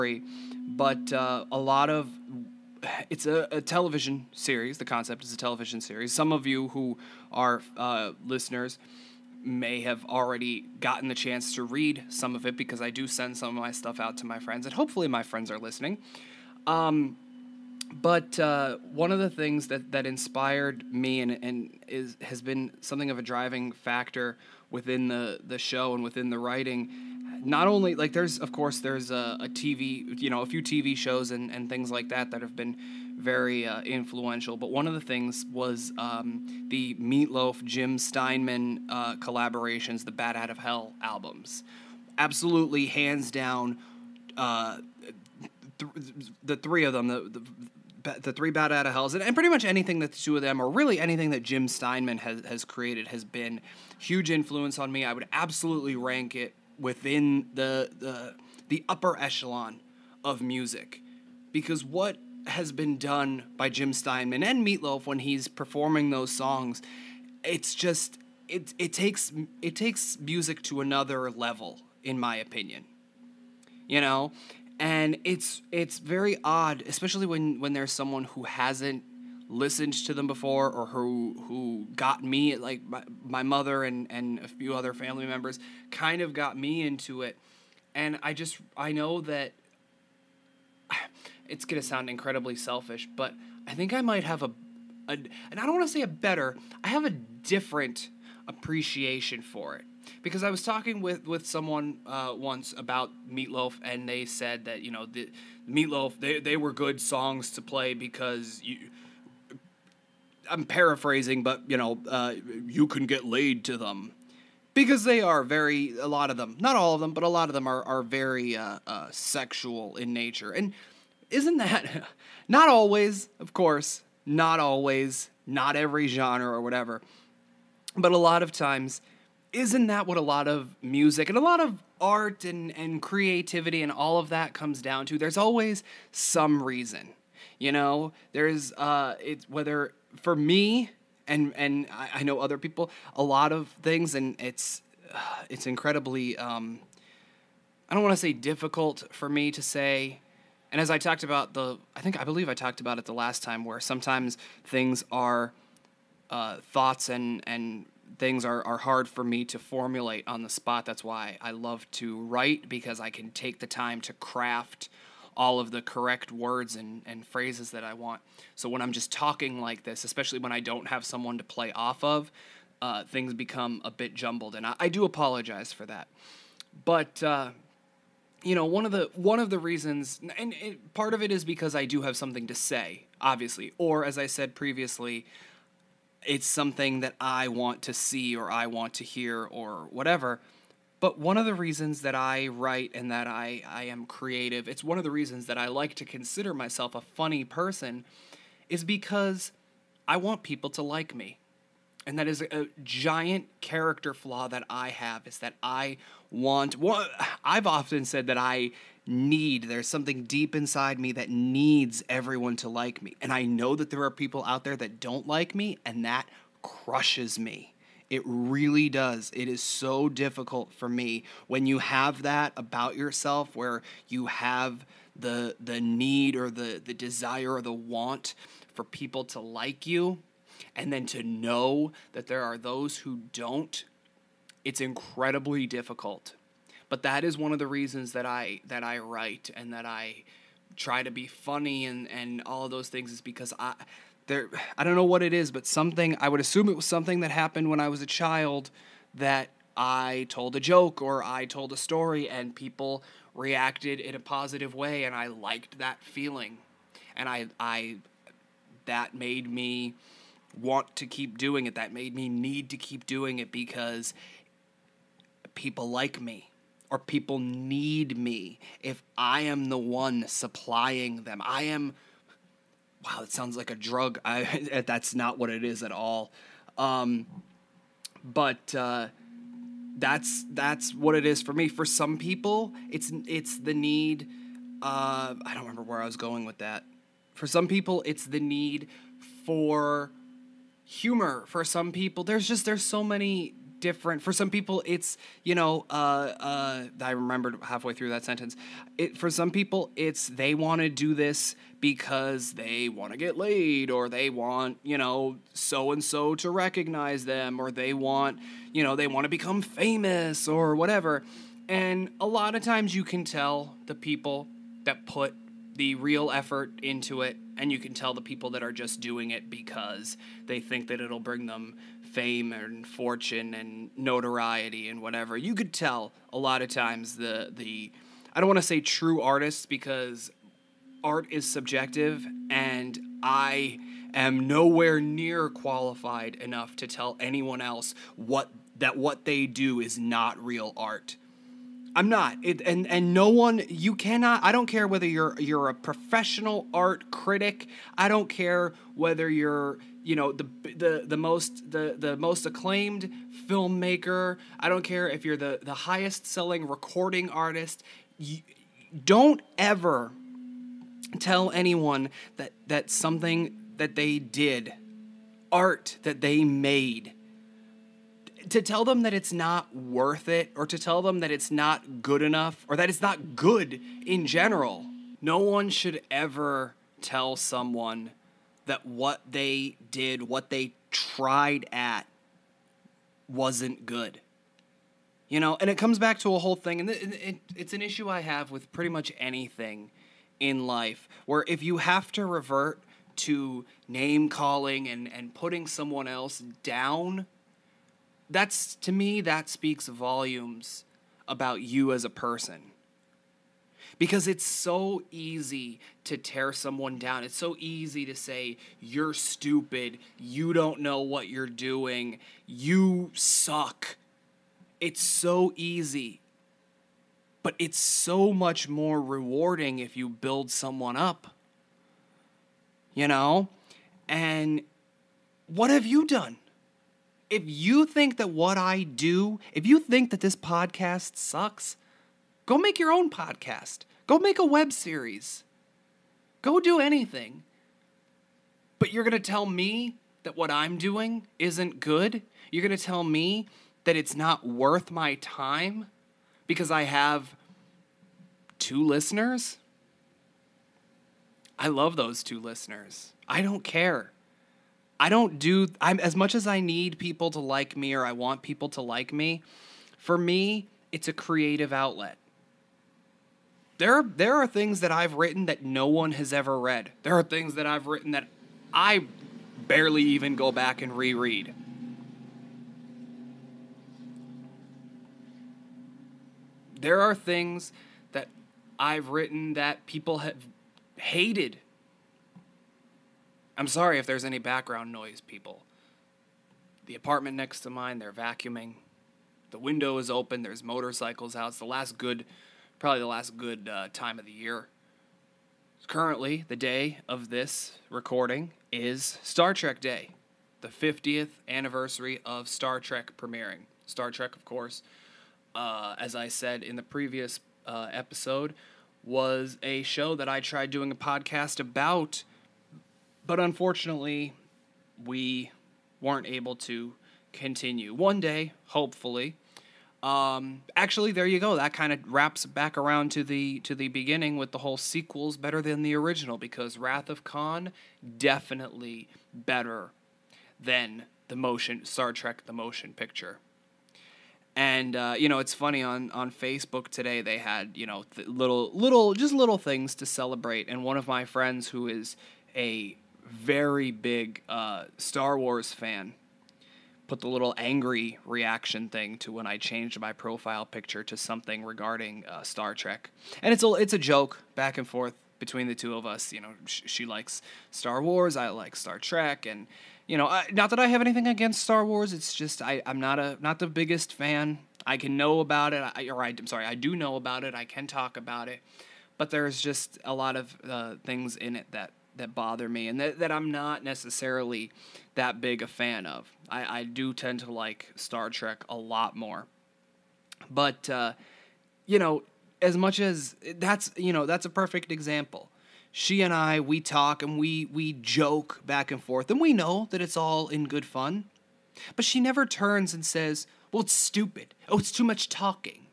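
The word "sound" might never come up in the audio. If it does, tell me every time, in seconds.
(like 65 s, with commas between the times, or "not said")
91 s, 273 s.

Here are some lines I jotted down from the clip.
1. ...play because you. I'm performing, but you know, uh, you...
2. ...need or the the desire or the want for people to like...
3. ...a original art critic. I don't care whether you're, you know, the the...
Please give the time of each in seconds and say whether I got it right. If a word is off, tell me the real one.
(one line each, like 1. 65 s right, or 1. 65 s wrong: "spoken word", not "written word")
1. 107 s wrong: "paraphrasing", not "performing"
2. 225 s right
3. 345 s wrong: "professional", not "original".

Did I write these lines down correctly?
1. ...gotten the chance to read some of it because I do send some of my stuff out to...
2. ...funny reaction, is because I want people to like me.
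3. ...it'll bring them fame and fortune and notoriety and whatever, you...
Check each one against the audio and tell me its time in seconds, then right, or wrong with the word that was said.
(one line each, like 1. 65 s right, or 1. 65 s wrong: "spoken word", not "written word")
1. 10 s right
2. 197 s wrong: "person", not "reaction"
3. 321 s right.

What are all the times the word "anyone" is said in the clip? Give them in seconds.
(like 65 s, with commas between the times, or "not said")
337 s, 361 s.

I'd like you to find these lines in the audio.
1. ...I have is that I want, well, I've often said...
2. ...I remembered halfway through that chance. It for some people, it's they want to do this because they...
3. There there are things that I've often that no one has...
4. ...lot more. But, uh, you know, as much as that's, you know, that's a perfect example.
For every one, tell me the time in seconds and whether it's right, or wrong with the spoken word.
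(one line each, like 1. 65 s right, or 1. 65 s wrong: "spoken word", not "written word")
1. 204 s right
2. 297 s wrong: "sentence", not "chance"
3. 463 s wrong: "written", not "often"
4. 578 s right.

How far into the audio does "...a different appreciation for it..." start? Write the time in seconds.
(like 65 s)
97 s.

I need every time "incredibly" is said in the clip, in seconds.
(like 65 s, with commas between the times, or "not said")
92 s, 145 s, 234 s.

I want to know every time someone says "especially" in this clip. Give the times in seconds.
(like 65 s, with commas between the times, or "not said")
76 s, 170 s.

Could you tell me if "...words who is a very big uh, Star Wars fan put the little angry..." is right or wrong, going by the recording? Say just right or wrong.
wrong.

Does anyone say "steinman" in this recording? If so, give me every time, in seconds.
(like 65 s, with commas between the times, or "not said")
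37 s, 51 s, 63 s.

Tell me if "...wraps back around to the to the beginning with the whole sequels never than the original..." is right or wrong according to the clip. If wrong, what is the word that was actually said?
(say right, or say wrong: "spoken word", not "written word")
wrong: "better", not "never".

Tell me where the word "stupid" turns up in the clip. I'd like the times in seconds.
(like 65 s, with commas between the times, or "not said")
409 s, 593 s.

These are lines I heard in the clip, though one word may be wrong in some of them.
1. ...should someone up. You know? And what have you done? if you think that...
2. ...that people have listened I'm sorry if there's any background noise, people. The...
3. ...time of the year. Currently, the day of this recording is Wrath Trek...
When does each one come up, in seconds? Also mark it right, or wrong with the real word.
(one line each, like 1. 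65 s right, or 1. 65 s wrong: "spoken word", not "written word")
1. 420 s wrong: "build", not "should"
2. 479 s wrong: "hated", not "listened"
3. 493 s wrong: "Star", not "Wrath".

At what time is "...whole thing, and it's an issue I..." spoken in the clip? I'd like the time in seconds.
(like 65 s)
386 s.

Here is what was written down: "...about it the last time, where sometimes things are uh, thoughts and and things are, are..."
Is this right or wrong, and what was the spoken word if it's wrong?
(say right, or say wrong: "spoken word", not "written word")
right.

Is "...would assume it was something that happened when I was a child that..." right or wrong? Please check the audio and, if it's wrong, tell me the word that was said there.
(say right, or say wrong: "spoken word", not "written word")
right.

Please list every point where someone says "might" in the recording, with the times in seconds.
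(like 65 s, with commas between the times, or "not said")
94 s.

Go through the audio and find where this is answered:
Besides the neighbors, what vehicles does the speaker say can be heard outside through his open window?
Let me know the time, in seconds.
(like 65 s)
490 s.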